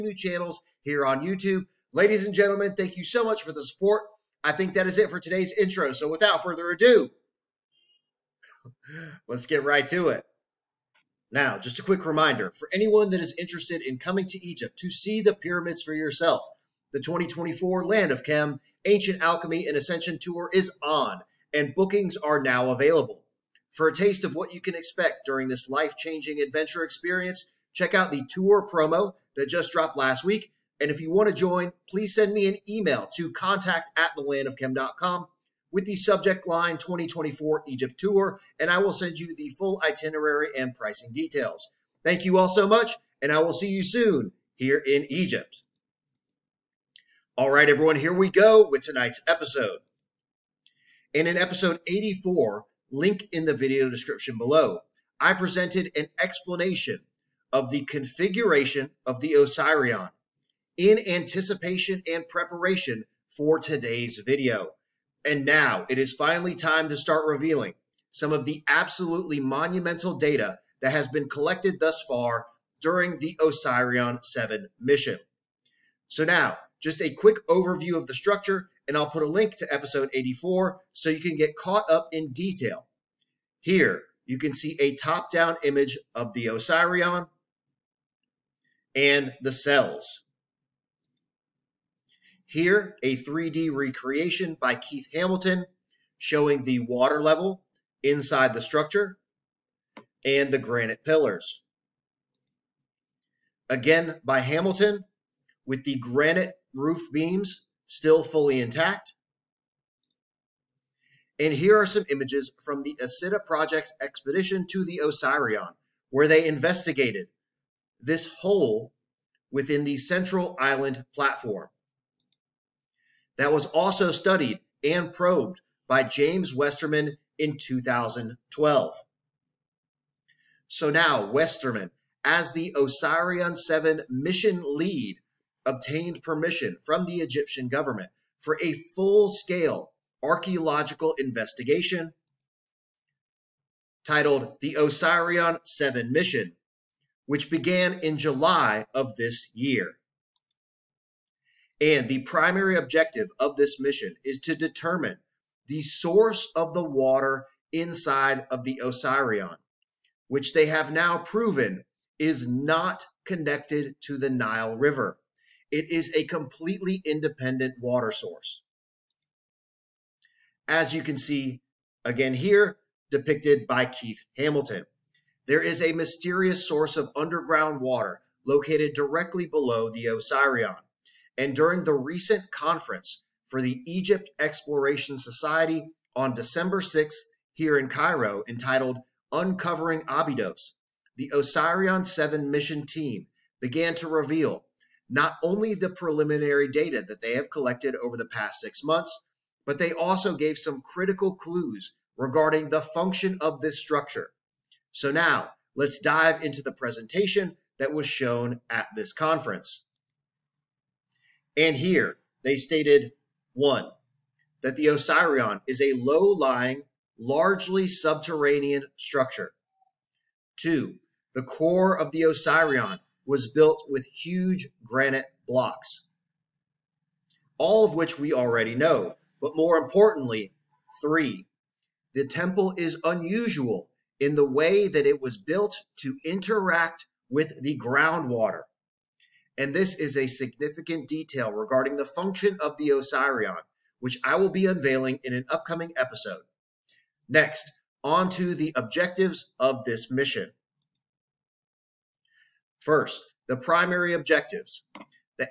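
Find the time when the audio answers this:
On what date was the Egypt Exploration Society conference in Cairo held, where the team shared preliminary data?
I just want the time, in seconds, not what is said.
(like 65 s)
186 s.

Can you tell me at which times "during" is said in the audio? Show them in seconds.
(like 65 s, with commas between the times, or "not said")
25 s, 72 s, 181 s.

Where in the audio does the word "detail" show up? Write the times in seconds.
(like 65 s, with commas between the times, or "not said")
41 s, 82 s, 241 s.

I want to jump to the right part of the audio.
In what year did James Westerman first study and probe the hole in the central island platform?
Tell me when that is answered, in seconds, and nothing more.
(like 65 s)
127 s.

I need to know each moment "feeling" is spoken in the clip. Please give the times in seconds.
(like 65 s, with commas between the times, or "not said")
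not said.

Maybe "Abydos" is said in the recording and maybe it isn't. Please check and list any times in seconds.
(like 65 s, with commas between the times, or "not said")
190 s.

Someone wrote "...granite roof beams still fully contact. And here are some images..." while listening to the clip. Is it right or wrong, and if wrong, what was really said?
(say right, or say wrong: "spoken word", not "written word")
wrong: "intact", not "contact".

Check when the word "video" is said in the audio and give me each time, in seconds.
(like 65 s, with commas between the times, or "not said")
53 s, 64 s.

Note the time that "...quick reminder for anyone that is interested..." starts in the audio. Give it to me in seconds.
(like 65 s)
11 s.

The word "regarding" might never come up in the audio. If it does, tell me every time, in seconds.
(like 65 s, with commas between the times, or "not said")
202 s, 241 s.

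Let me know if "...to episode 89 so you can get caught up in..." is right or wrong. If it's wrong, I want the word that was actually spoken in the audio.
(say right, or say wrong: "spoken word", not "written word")
wrong: "84", not "89".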